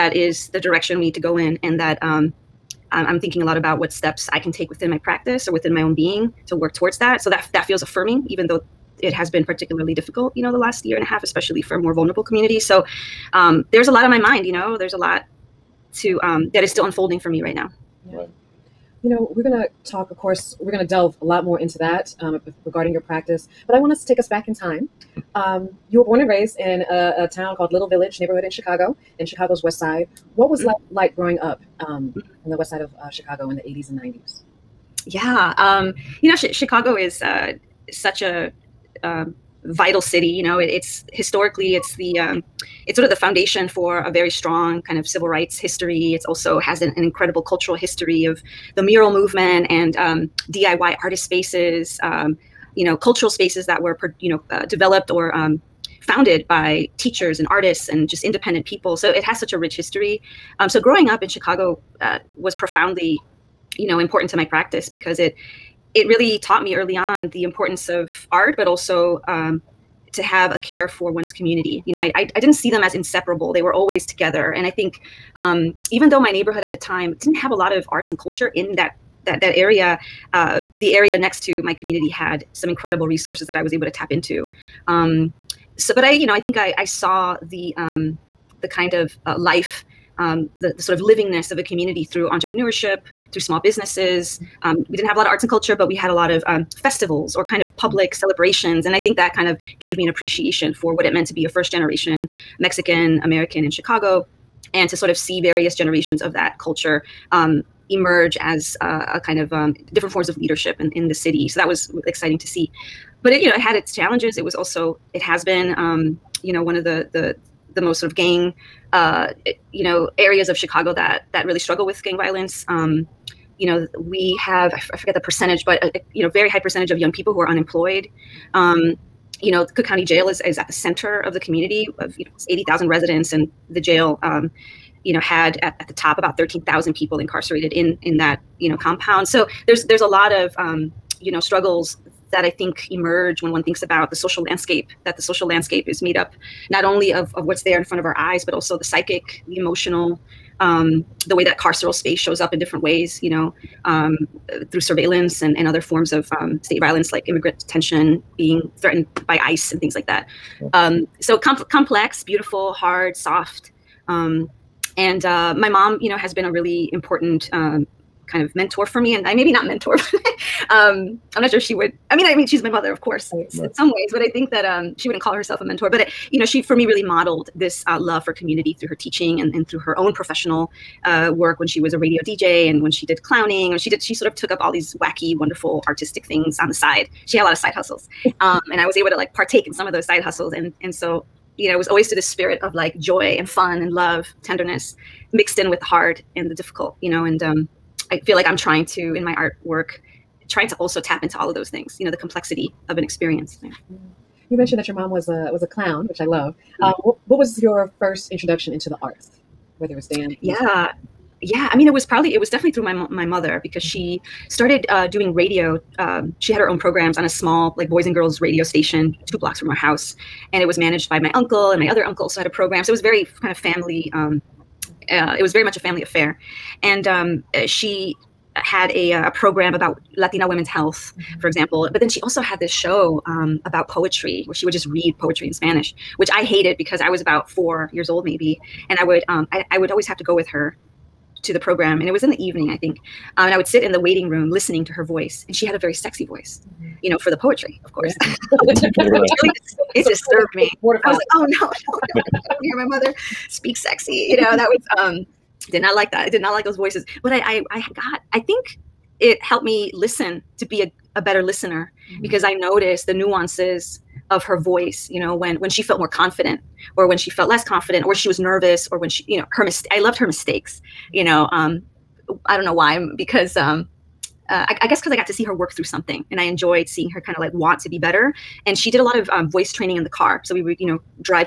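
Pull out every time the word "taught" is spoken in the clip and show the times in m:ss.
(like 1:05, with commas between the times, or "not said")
1:06.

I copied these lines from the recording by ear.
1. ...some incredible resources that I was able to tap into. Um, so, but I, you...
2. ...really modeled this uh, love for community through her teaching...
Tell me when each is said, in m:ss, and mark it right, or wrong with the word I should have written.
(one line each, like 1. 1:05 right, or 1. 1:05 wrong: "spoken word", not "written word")
1. 1:22 right
2. 2:56 right.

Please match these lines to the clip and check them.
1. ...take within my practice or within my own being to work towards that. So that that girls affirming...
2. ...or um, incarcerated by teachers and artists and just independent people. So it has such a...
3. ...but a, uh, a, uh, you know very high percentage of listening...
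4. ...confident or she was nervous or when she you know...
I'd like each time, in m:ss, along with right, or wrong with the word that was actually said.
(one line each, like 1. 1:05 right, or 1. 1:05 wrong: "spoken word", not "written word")
1. 0:04 wrong: "feels", not "girls"
2. 0:55 wrong: "founded", not "incarcerated"
3. 2:05 wrong: "young", not "listening"
4. 4:27 right.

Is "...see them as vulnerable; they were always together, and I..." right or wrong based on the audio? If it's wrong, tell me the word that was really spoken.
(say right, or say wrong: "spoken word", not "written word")
wrong: "inseparable", not "vulnerable".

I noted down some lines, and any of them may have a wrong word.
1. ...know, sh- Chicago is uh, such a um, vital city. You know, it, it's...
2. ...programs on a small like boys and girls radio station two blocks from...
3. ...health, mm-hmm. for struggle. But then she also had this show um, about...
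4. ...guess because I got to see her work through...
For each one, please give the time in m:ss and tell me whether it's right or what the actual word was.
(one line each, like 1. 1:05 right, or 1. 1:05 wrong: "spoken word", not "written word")
1. 0:36 right
2. 3:36 right
3. 3:50 wrong: "example", not "struggle"
4. 4:34 right.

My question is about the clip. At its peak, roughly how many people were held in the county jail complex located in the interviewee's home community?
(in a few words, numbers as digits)
13,000.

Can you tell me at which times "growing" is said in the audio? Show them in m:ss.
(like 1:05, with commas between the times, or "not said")
0:31, 1:00.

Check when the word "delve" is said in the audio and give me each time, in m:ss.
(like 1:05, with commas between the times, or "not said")
0:20.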